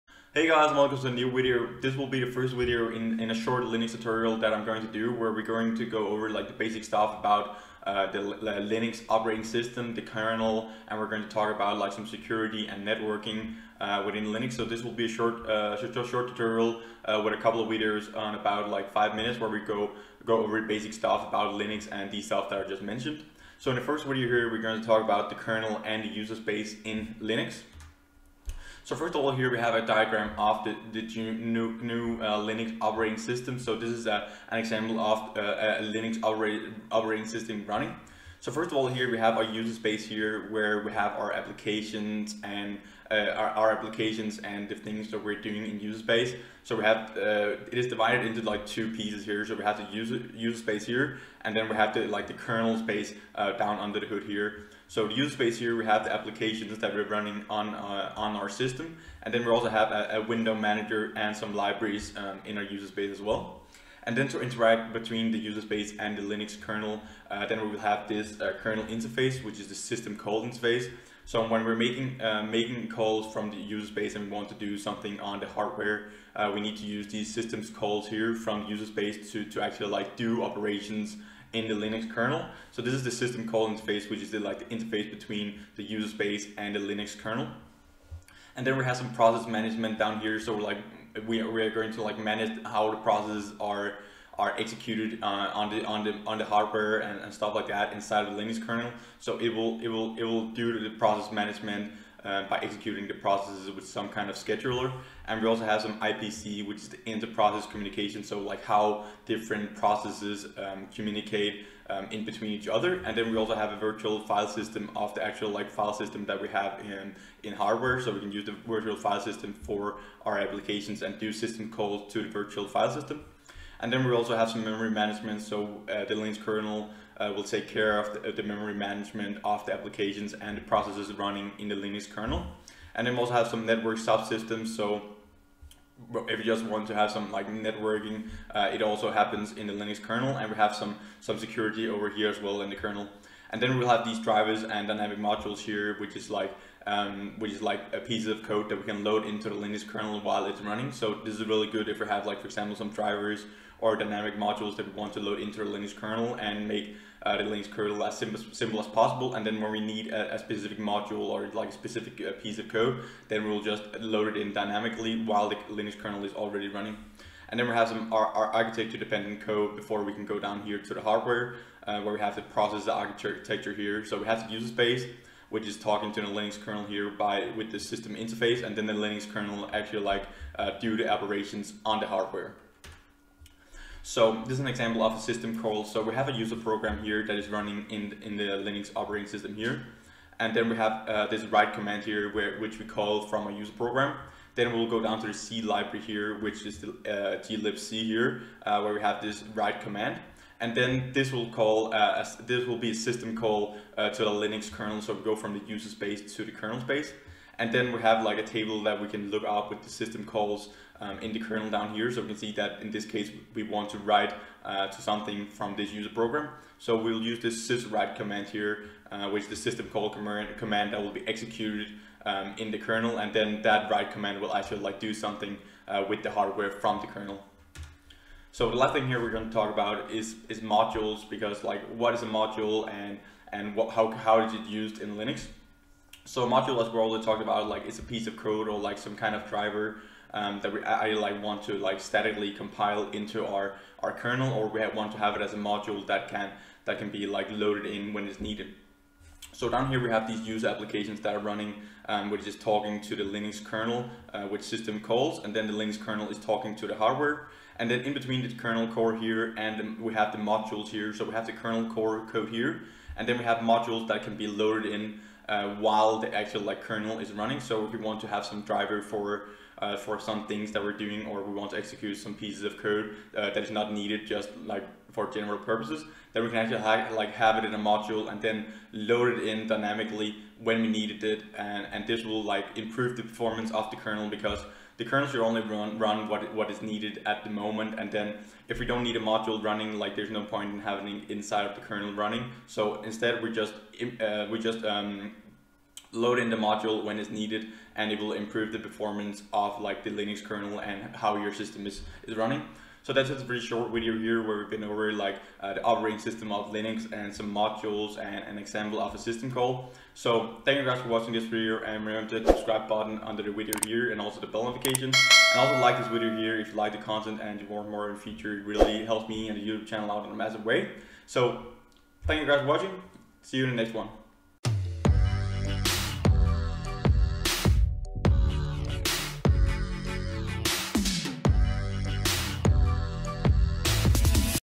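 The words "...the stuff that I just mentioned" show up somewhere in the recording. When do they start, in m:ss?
0:22.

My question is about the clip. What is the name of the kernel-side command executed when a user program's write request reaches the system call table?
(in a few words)
syswrite.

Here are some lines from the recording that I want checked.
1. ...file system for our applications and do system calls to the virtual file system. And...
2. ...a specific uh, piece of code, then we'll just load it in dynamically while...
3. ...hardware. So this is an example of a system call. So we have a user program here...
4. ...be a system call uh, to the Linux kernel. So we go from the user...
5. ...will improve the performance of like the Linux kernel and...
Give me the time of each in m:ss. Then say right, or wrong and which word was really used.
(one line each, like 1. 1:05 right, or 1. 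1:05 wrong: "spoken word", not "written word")
1. 1:58 right
2. 2:41 right
3. 3:02 right
4. 3:22 right
5. 4:58 right.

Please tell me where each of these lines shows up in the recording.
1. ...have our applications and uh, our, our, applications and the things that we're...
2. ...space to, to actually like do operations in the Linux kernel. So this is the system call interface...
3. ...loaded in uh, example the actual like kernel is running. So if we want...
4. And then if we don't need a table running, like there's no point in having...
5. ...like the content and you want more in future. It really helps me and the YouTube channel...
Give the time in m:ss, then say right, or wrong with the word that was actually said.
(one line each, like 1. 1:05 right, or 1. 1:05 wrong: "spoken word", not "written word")
1. 0:40 right
2. 1:18 right
3. 4:24 wrong: "while", not "example"
4. 4:47 wrong: "module", not "table"
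5. 5:16 right.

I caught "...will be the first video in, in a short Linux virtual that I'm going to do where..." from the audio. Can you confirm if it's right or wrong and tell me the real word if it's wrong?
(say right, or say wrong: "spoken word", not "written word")
wrong: "tutorial", not "virtual".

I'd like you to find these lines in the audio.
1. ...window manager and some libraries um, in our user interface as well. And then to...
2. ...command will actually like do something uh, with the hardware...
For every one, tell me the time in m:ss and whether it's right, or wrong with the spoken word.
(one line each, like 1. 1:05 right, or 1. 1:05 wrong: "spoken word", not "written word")
1. 1:00 wrong: "space", not "interface"
2. 3:44 right.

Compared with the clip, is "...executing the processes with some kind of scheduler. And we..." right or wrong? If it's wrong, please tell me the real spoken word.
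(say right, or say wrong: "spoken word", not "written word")
right.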